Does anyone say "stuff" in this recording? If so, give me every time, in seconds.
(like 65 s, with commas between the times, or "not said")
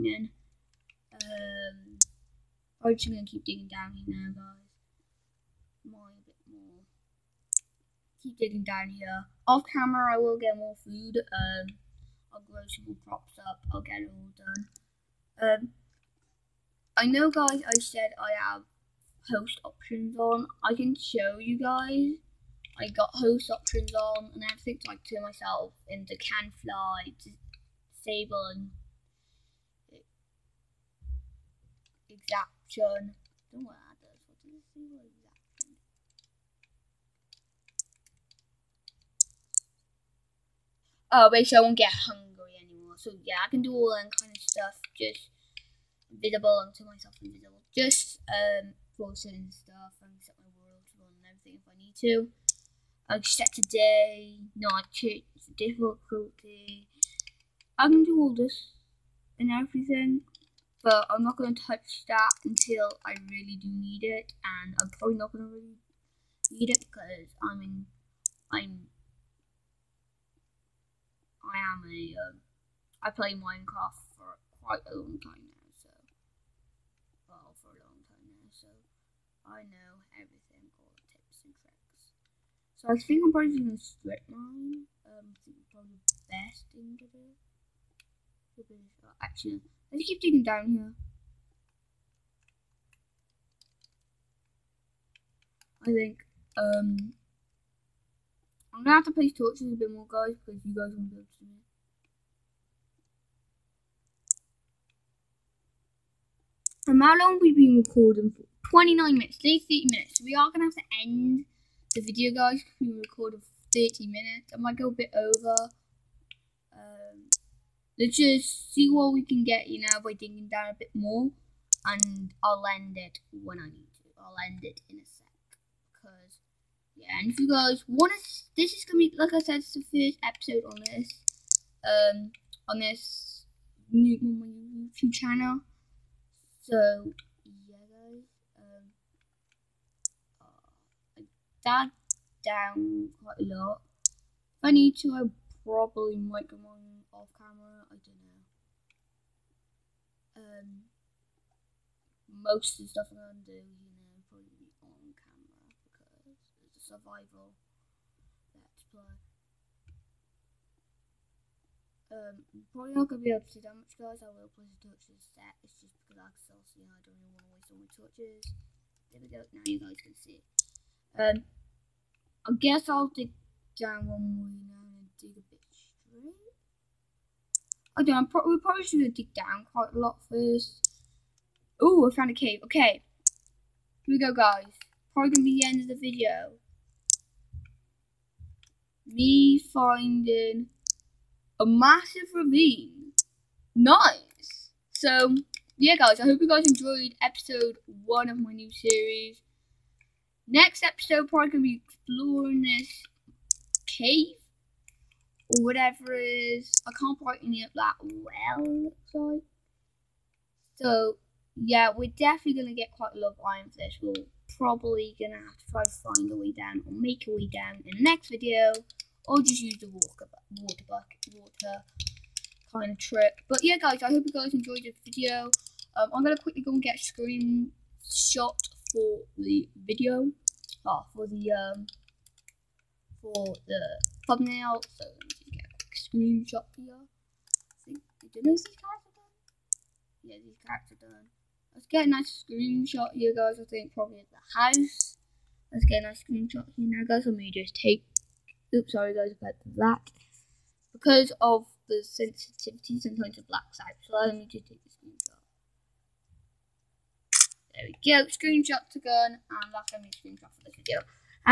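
44 s, 49 s, 152 s.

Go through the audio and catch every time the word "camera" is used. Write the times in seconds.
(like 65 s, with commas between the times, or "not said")
9 s, 147 s.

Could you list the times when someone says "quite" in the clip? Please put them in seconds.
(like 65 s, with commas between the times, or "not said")
74 s, 143 s, 179 s, 207 s, 212 s.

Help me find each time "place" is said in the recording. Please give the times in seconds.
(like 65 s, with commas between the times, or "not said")
99 s, 164 s.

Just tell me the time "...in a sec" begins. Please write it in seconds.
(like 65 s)
124 s.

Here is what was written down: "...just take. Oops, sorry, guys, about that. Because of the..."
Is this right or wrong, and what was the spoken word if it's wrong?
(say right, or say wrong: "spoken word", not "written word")
right.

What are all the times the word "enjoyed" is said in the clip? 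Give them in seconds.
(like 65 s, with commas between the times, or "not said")
196 s, 224 s.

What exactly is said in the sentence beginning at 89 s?
Actually, let's keep digging down here.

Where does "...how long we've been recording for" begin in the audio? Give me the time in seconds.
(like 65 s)
107 s.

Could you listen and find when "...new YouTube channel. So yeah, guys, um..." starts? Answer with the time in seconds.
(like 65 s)
134 s.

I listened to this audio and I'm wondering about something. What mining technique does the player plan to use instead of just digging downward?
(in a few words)
strip mine.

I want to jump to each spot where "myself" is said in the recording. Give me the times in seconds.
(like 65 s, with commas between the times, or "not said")
25 s, 46 s.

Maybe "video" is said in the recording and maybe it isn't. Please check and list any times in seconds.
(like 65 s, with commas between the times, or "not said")
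111 s, 185 s, 218 s, 225 s, 229 s, 260 s.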